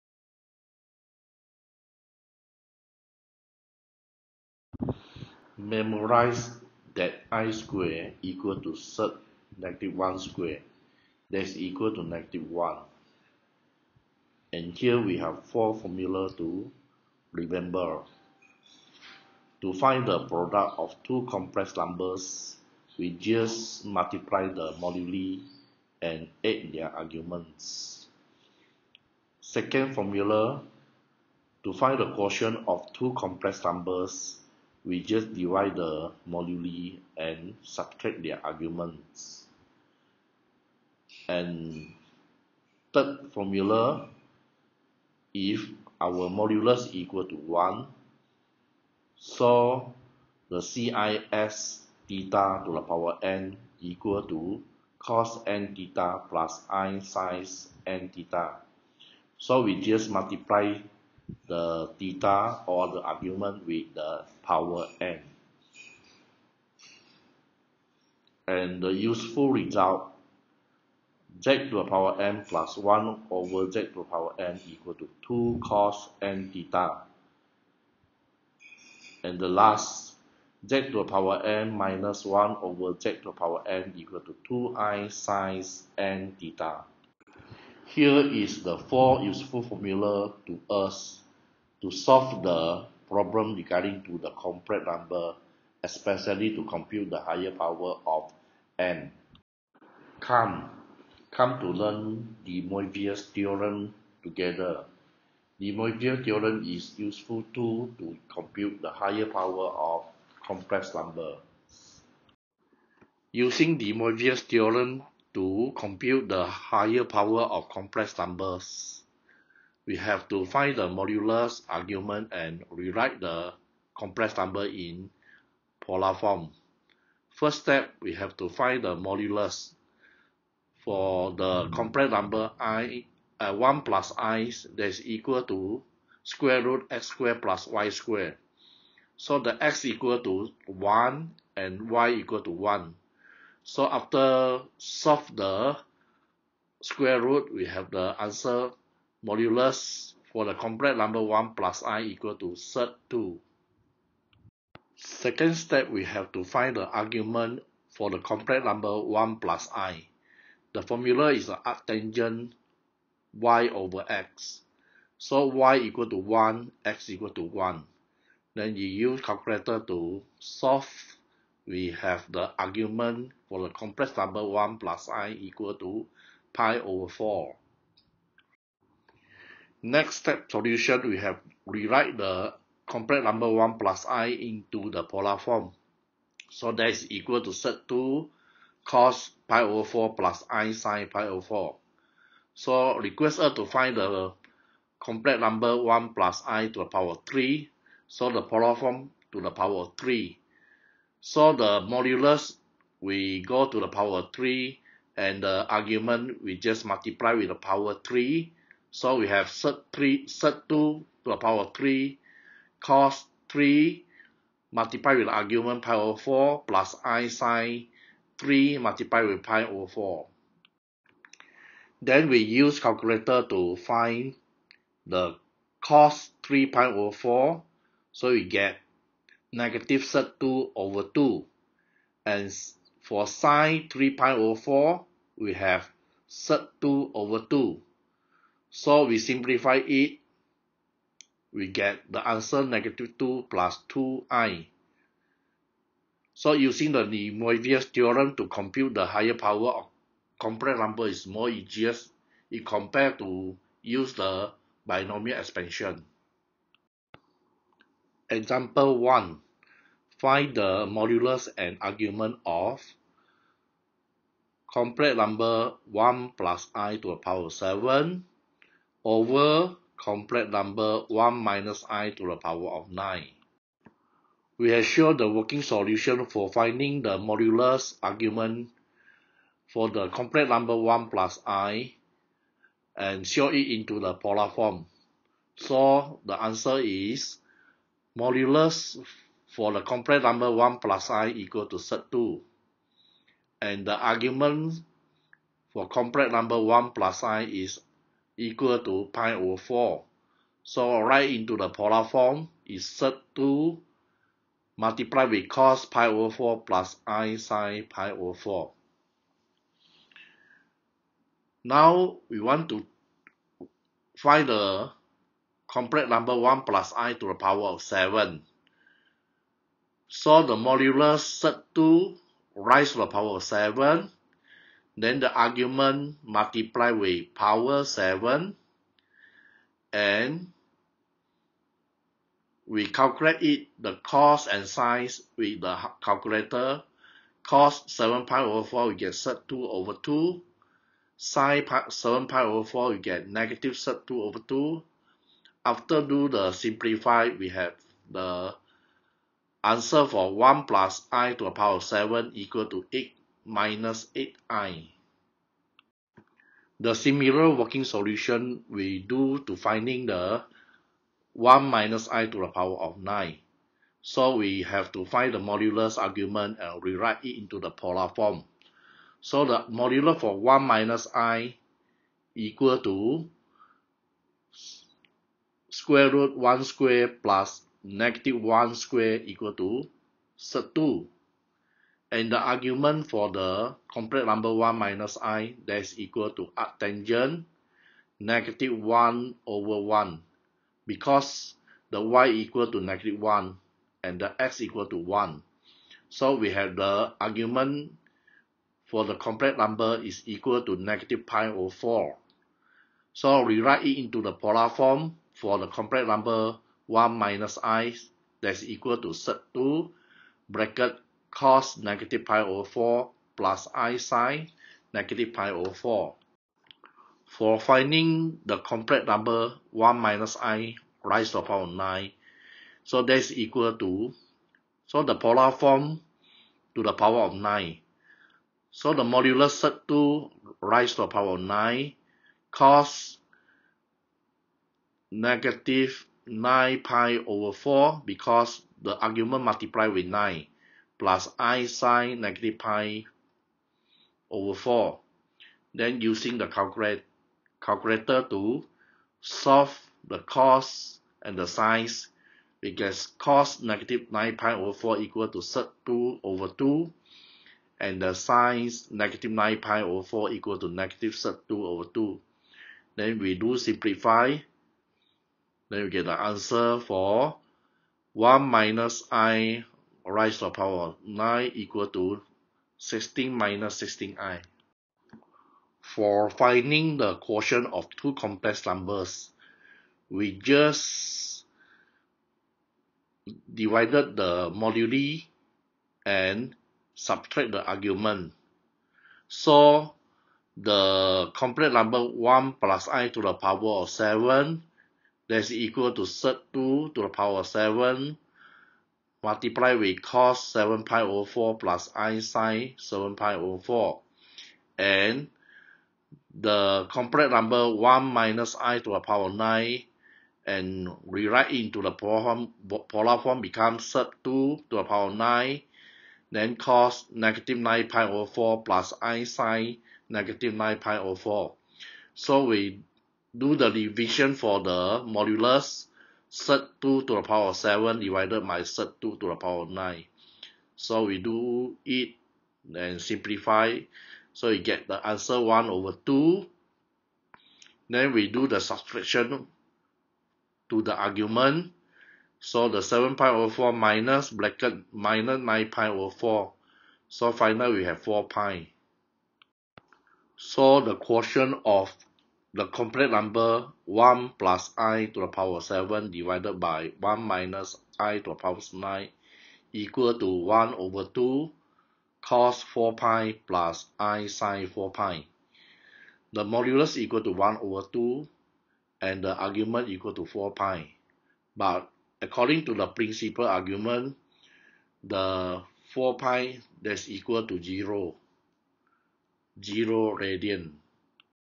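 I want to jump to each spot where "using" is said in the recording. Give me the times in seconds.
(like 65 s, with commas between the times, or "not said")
113 s, 246 s, 445 s.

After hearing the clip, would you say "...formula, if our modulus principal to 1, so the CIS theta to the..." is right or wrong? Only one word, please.
wrong.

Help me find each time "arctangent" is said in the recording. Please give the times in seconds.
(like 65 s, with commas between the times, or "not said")
161 s, 386 s.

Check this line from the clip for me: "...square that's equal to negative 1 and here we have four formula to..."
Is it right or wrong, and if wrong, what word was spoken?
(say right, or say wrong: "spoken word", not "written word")
right.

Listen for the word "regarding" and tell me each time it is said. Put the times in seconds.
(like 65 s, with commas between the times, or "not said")
93 s.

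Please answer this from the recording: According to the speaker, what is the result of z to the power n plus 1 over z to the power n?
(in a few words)
2 cos n theta.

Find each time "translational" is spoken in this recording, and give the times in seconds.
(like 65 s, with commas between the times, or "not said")
not said.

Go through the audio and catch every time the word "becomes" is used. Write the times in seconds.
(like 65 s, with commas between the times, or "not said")
513 s.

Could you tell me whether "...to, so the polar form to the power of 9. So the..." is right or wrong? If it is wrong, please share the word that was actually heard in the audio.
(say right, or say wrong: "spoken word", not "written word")
right.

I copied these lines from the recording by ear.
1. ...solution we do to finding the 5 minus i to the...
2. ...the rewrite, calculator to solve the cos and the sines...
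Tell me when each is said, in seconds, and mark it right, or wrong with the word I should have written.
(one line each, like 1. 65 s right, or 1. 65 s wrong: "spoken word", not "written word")
1. 357 s wrong: "1", not "5"
2. 446 s wrong: "calculate", not "rewrite".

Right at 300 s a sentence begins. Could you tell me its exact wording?
So write into the polar form is set 2 multiplied with cos pi over 4 plus i sine pi over 4.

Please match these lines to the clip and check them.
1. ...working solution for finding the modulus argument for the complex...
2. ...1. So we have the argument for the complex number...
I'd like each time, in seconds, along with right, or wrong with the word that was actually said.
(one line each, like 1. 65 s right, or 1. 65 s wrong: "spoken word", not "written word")
1. 275 s right
2. 394 s right.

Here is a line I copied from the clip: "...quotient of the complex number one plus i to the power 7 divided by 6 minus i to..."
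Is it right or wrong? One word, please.
wrong.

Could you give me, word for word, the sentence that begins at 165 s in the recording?
So y equal to 1, x equal to 1.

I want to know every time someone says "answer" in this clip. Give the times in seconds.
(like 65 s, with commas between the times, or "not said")
148 s, 242 s, 286 s, 349 s, 466 s, 535 s.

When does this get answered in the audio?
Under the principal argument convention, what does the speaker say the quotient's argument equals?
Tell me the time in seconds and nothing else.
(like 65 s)
577 s.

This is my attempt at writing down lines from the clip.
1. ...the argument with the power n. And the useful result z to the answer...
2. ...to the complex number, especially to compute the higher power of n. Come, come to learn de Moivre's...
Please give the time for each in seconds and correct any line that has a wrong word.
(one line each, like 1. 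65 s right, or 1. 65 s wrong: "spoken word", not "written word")
1. 62 s wrong: "power", not "answer"
2. 94 s right.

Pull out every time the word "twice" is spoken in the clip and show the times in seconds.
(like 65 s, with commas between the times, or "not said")
not said.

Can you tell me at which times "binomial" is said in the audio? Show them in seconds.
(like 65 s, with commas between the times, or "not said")
254 s.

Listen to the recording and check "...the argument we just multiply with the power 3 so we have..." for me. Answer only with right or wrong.
right.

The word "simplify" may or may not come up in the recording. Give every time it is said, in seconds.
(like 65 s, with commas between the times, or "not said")
239 s, 346 s, 463 s, 533 s.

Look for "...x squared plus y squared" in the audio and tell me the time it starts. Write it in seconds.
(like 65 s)
136 s.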